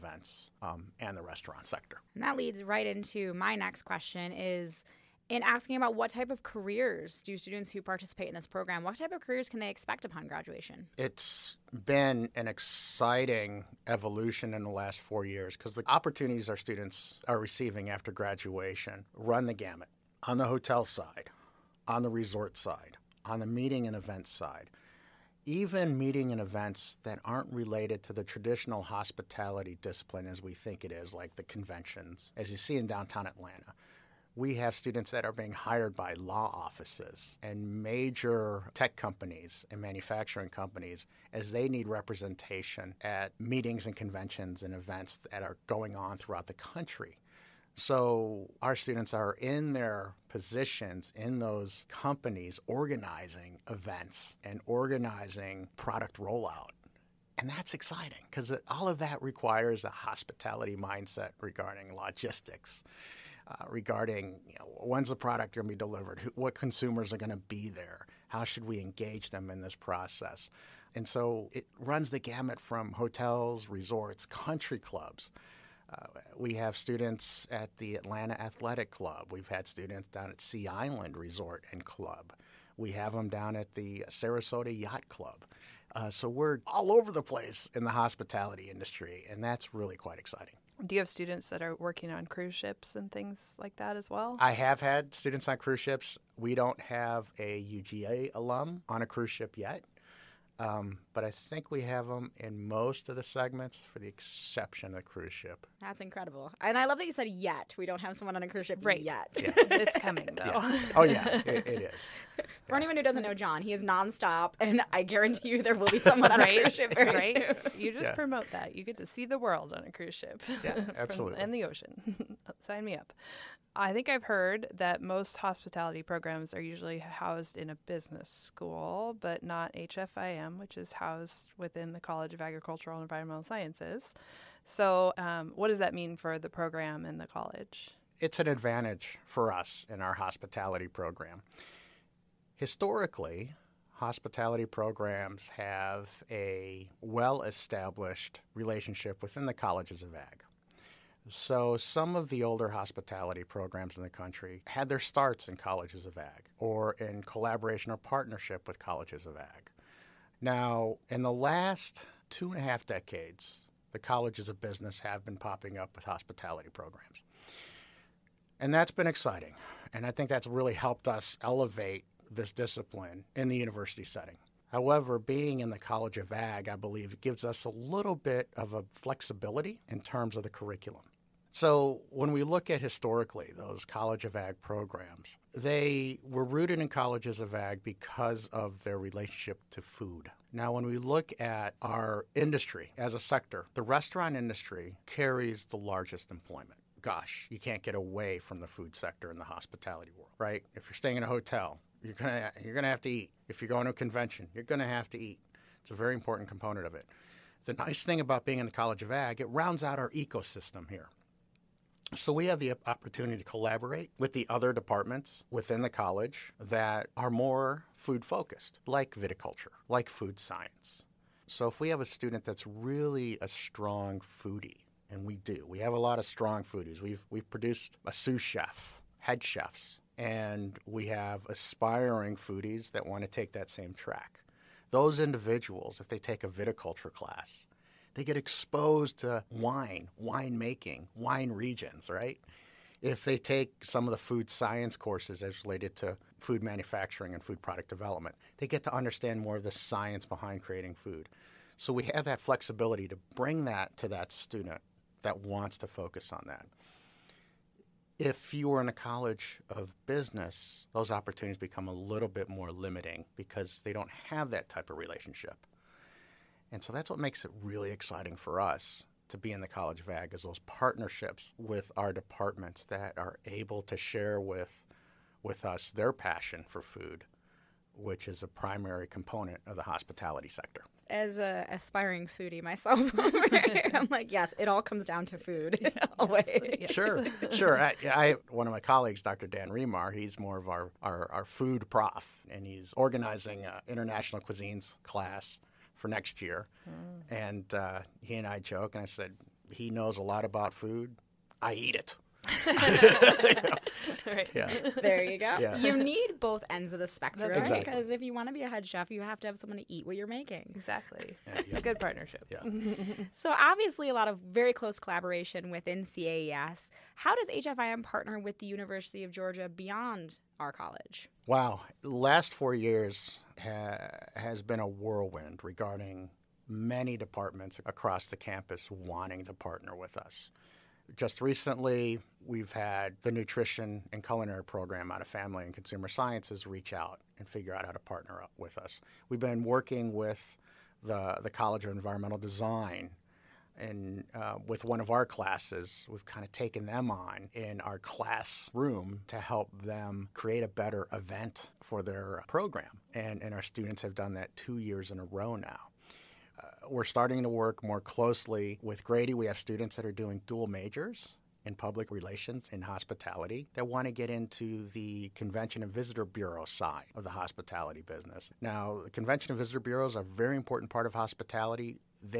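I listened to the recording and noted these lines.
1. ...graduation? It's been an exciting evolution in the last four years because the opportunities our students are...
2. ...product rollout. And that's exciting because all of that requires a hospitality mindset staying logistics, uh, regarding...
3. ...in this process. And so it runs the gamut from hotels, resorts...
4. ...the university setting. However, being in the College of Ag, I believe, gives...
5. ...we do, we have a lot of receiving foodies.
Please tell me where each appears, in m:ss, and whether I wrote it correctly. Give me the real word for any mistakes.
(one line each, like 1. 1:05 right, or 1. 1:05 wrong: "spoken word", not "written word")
1. 0:10 right
2. 0:55 wrong: "regarding", not "staying"
3. 1:09 right
4. 2:53 right
5. 3:45 wrong: "strong", not "receiving".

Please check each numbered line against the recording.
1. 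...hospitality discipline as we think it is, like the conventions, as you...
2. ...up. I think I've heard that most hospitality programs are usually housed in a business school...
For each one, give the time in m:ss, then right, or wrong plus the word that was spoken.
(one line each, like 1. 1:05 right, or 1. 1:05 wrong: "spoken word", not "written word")
1. 0:28 right
2. 2:02 right.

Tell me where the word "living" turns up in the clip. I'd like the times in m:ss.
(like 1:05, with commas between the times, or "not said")
not said.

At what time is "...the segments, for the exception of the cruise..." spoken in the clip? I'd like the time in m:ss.
1:43.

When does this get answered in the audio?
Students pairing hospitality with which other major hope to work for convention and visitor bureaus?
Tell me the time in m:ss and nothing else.
6:01.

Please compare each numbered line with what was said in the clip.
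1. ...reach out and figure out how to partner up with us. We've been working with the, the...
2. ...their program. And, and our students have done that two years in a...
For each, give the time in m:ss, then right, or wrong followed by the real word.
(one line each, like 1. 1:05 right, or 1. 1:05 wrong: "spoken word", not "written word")
1. 5:36 right
2. 5:52 right.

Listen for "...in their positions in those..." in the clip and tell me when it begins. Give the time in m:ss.
0:49.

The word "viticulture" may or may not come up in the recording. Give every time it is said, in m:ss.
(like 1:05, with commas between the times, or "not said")
3:39, 3:56.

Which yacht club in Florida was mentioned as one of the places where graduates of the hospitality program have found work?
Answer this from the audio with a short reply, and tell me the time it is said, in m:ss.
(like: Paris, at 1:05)
Sarasota Yacht Club, at 1:24.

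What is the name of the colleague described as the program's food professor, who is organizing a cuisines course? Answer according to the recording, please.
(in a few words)
Dr. Dan Remar.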